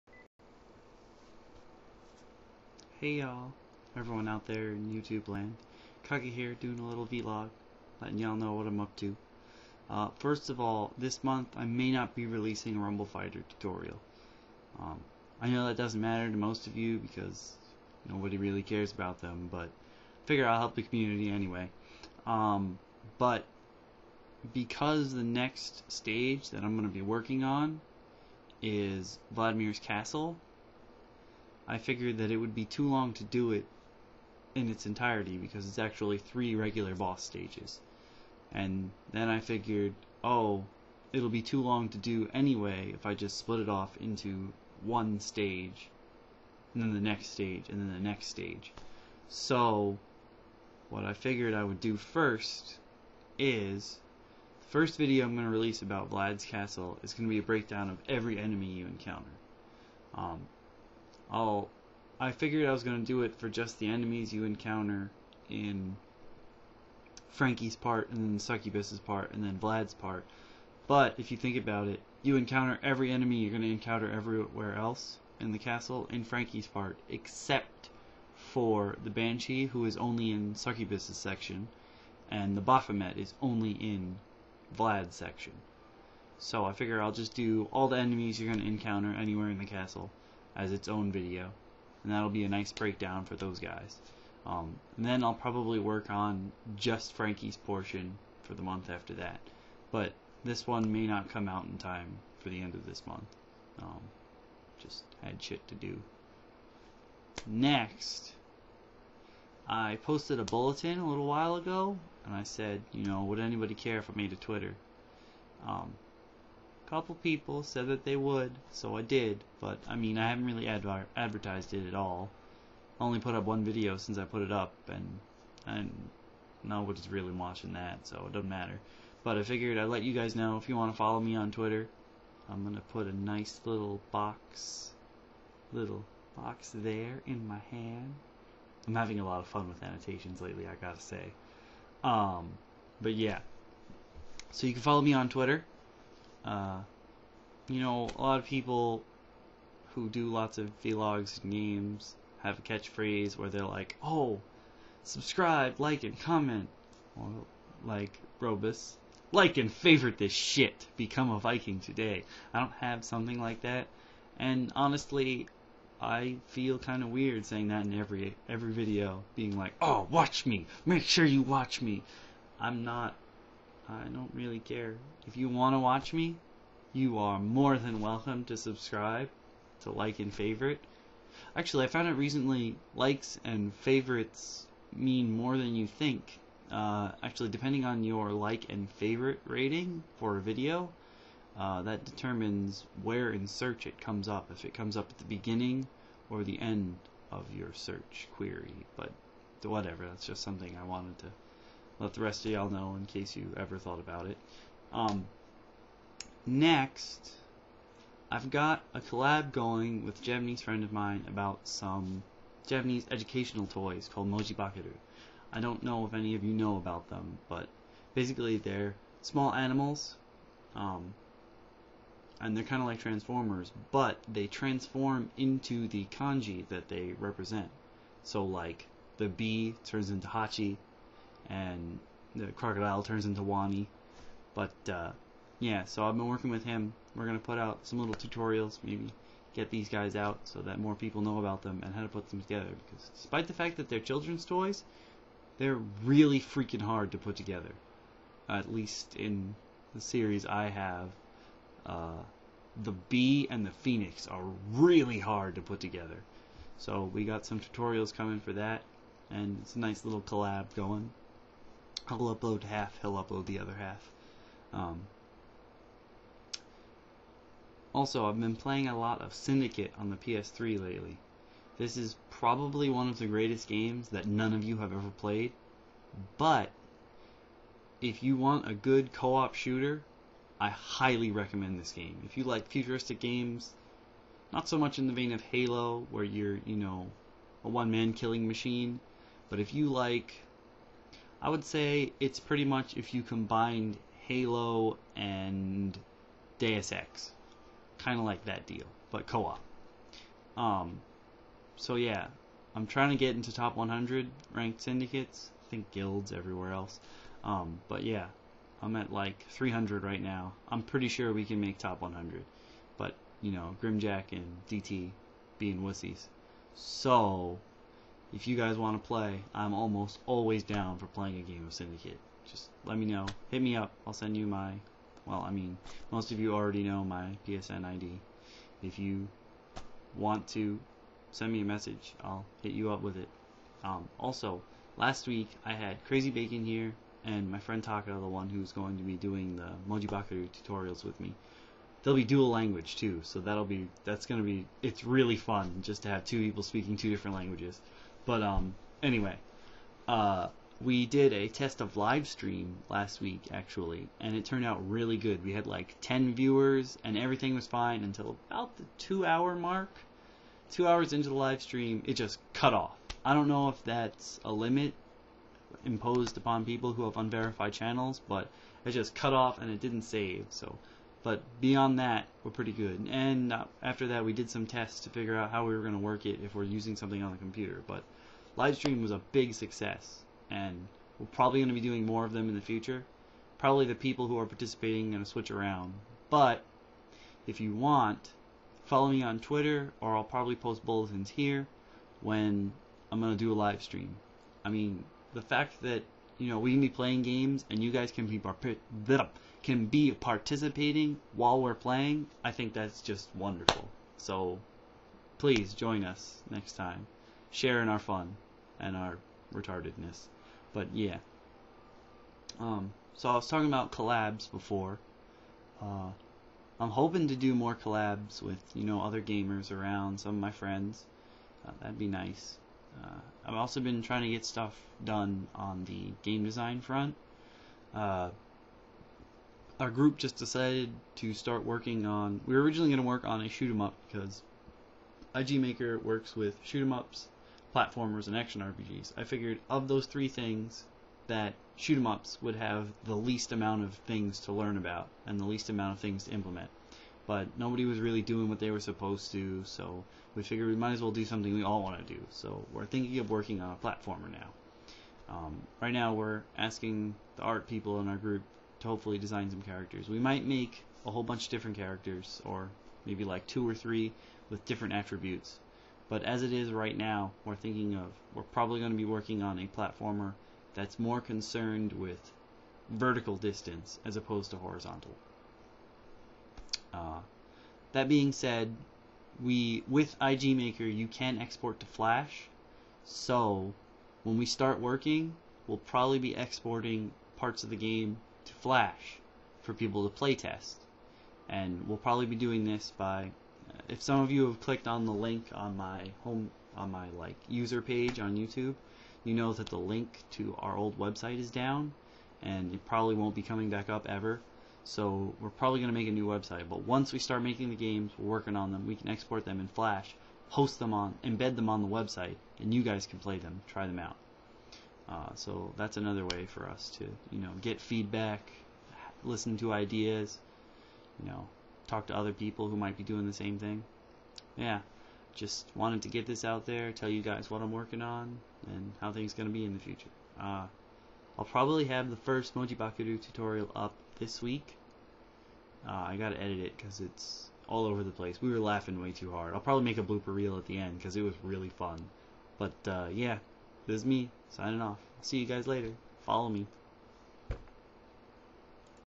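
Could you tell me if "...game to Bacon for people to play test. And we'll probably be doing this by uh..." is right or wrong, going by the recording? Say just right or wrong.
wrong.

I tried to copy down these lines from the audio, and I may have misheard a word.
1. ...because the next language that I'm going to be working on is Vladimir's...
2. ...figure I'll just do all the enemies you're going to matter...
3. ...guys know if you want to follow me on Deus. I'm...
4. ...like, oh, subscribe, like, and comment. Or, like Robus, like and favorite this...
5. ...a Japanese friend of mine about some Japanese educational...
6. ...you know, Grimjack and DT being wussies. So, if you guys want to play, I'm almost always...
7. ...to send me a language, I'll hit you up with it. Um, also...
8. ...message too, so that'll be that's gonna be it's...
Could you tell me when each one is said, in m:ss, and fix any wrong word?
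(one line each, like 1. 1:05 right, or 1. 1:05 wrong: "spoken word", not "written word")
1. 0:24 wrong: "stage", not "language"
2. 1:26 wrong: "encounter", not "matter"
3. 2:10 wrong: "Twitter", not "Deus"
4. 2:33 right
5. 3:30 right
6. 5:13 right
7. 5:30 wrong: "message", not "language"
8. 5:42 wrong: "language", not "message".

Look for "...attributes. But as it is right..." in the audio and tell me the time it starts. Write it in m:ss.
7:44.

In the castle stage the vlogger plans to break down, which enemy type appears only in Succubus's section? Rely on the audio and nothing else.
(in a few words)
Banshee.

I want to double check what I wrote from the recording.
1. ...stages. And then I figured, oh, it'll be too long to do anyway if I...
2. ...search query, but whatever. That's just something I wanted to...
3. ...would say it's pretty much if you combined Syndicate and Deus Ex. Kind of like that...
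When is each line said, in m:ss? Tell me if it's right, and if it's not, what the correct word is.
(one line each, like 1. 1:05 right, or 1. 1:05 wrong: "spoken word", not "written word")
1. 0:37 right
2. 3:17 right
3. 4:51 wrong: "Halo", not "Syndicate".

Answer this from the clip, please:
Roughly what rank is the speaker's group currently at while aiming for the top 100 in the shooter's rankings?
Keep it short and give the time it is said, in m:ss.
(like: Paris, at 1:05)
300, at 5:09.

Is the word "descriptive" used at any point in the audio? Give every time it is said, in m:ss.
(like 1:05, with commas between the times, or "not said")
not said.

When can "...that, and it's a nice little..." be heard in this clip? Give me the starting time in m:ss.
4:18.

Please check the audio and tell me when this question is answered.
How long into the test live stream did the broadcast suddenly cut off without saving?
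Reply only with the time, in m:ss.
6:00.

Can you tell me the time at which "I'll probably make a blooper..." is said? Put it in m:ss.
8:59.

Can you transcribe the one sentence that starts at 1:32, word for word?
And that'll be a nice breakdown for those guys.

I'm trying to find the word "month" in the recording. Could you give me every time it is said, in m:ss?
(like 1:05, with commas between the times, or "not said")
0:11, 1:38, 1:43.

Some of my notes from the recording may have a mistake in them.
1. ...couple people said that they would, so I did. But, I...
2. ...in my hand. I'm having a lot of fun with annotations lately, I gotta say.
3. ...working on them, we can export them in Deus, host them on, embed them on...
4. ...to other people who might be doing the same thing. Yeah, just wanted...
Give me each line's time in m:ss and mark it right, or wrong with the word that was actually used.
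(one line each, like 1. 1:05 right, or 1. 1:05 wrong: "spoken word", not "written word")
1. 1:56 right
2. 2:17 right
3. 8:28 wrong: "Flash", not "Deus"
4. 8:42 right.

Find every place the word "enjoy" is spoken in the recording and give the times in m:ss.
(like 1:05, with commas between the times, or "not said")
not said.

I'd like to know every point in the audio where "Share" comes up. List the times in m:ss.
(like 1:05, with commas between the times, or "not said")
6:47.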